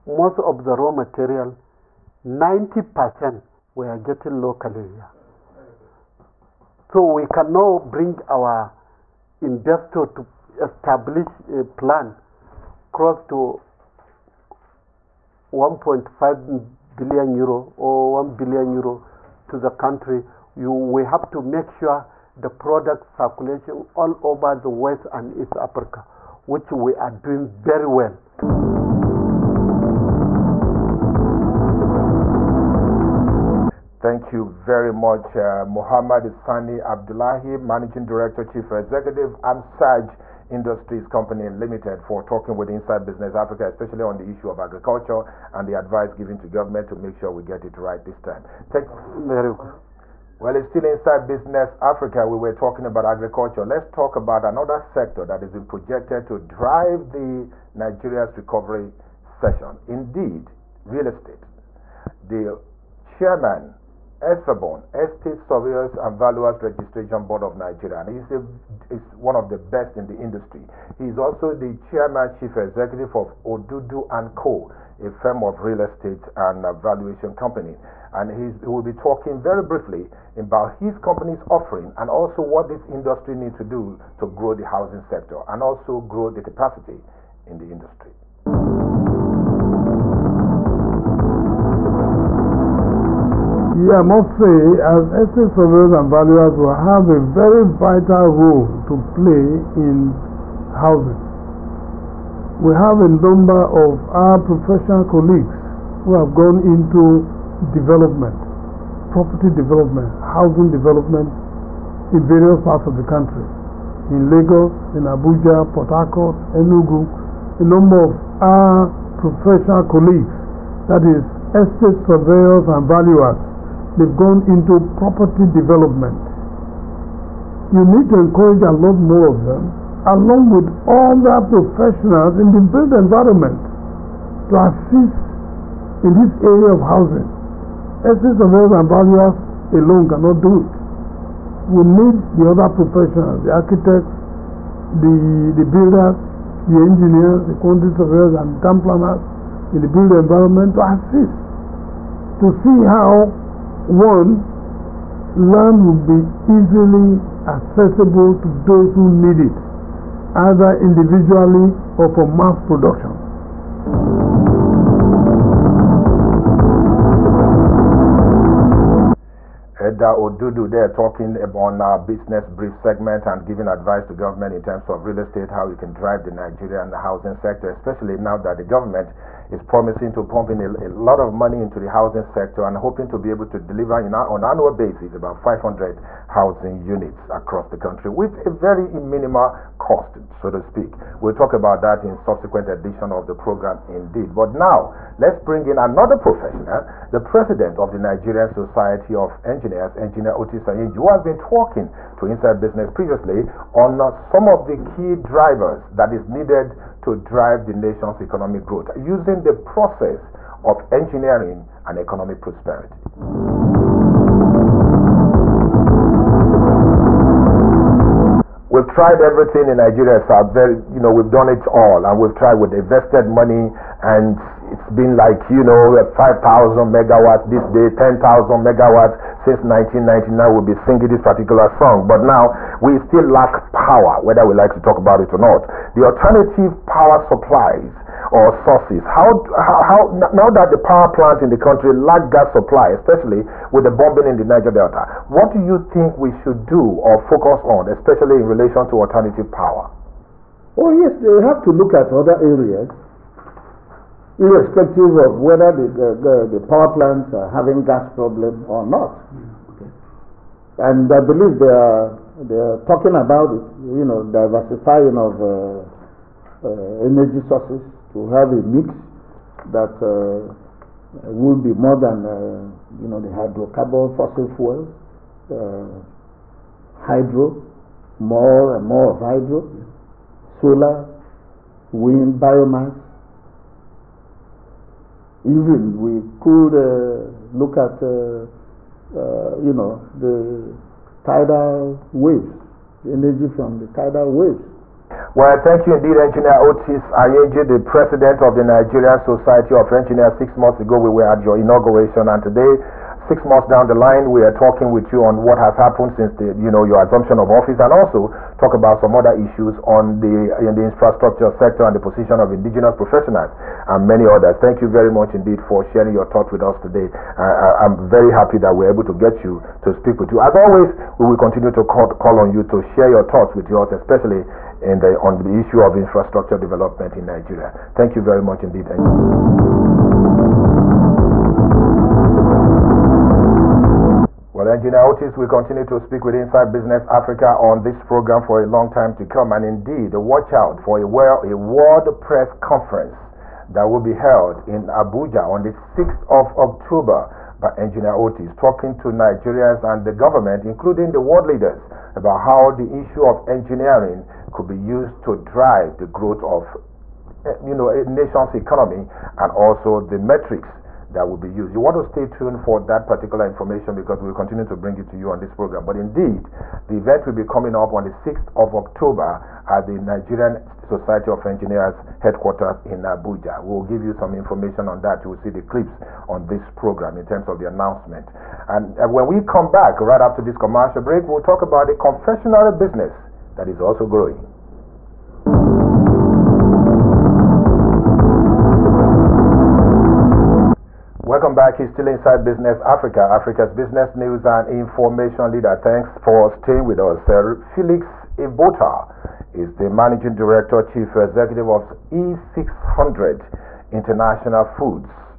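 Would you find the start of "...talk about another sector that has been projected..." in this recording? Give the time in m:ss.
0:53.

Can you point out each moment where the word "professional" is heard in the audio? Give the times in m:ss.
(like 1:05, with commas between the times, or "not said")
1:44, 1:59, 2:11, 2:22, 3:16, 5:12.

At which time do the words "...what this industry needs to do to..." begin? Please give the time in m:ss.
1:22.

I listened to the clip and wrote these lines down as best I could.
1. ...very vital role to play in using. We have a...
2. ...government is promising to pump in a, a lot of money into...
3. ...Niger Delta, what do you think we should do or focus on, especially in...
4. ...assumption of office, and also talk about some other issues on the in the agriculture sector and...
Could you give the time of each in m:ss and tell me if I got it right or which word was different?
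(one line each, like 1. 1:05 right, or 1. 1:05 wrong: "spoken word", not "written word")
1. 1:37 wrong: "housing", not "using"
2. 2:58 right
3. 4:04 right
4. 5:07 wrong: "infrastructure", not "agriculture".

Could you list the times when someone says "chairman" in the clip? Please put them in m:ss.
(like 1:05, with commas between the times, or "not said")
1:03, 1:11.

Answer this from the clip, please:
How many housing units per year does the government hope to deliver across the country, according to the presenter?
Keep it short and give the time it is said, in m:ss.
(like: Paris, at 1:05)
500, at 3:05.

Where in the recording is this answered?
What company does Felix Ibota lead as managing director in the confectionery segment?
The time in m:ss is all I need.
6:41.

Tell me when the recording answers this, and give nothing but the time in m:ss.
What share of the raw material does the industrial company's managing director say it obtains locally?
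0:02.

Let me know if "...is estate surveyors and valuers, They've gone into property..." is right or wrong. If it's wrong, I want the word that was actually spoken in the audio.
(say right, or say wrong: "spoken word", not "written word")
right.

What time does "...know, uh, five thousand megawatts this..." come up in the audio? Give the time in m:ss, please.
3:45.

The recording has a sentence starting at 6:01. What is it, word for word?
You want to stay tuned for that particular information because we'll continue to bring it to you on this program.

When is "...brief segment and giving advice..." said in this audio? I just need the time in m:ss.
2:52.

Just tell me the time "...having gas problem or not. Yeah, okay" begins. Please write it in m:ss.
4:17.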